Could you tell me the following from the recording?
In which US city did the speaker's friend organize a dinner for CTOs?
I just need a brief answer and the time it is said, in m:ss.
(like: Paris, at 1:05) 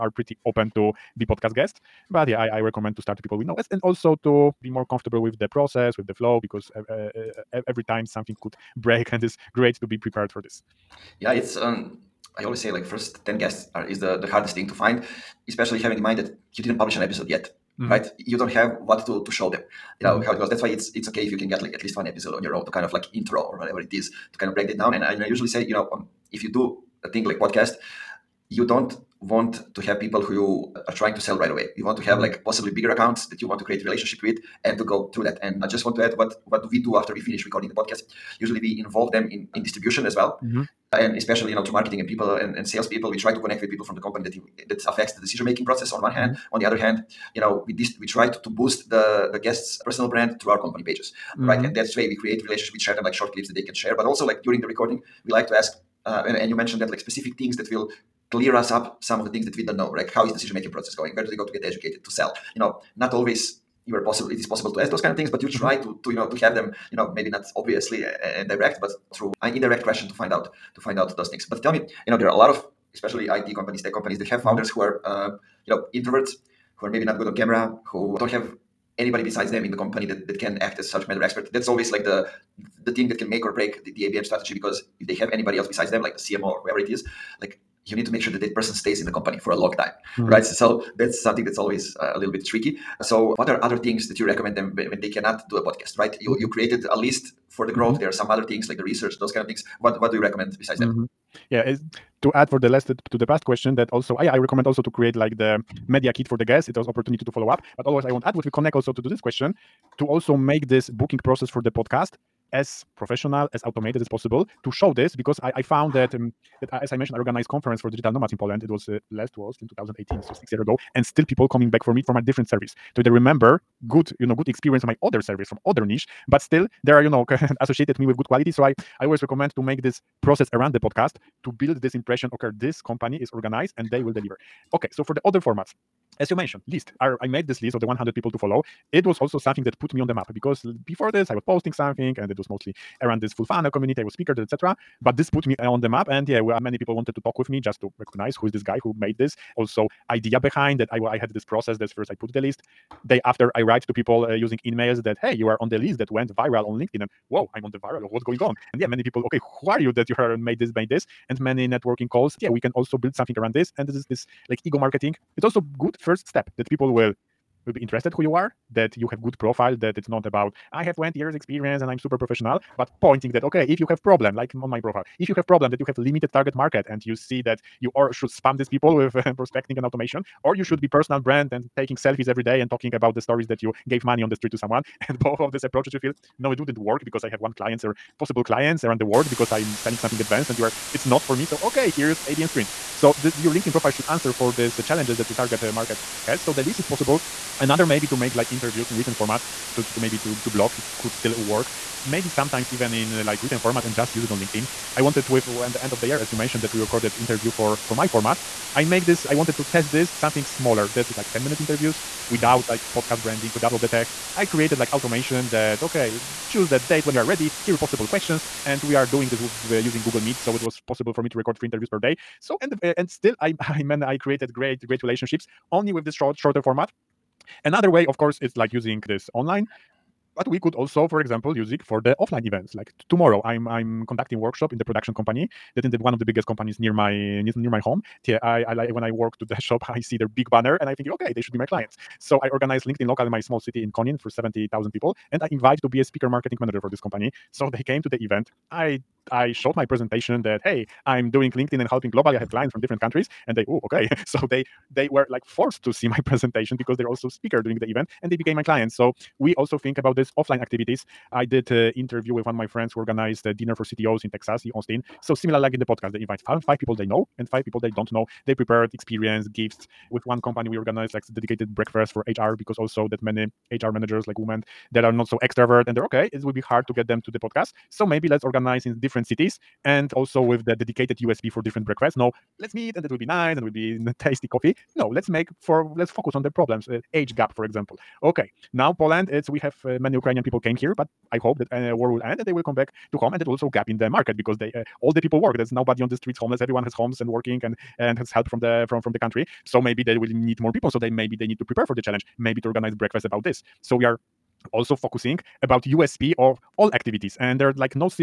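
Austin, at 4:24.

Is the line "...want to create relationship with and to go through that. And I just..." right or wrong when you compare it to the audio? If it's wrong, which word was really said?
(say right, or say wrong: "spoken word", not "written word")
right.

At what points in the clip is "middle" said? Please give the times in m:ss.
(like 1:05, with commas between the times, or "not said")
not said.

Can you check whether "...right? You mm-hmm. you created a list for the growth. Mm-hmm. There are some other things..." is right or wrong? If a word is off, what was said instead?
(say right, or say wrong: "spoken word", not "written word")
right.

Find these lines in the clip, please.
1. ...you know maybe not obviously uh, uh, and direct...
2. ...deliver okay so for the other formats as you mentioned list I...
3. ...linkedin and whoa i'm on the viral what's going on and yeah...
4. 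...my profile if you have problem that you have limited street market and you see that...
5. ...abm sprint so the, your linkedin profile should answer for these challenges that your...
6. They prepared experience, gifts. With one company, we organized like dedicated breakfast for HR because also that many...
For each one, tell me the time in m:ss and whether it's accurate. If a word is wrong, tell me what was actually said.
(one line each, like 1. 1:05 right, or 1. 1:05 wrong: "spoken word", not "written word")
1. 1:06 right
2. 2:14 right
3. 2:36 right
4. 2:54 wrong: "target", not "street"
5. 3:12 right
6. 4:28 right.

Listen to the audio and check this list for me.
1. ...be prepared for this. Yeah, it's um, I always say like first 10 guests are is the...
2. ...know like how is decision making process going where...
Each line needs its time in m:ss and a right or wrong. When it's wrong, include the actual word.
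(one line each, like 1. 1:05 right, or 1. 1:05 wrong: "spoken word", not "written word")
1. 0:09 right
2. 0:59 right.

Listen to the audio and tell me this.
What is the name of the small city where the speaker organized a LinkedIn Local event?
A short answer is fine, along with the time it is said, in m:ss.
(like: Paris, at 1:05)
Konin, at 4:03.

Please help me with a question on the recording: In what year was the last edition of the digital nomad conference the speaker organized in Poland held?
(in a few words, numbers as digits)
2018.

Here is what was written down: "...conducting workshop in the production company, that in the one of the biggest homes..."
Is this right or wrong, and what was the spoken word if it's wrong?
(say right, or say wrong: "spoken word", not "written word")
wrong: "companies", not "homes".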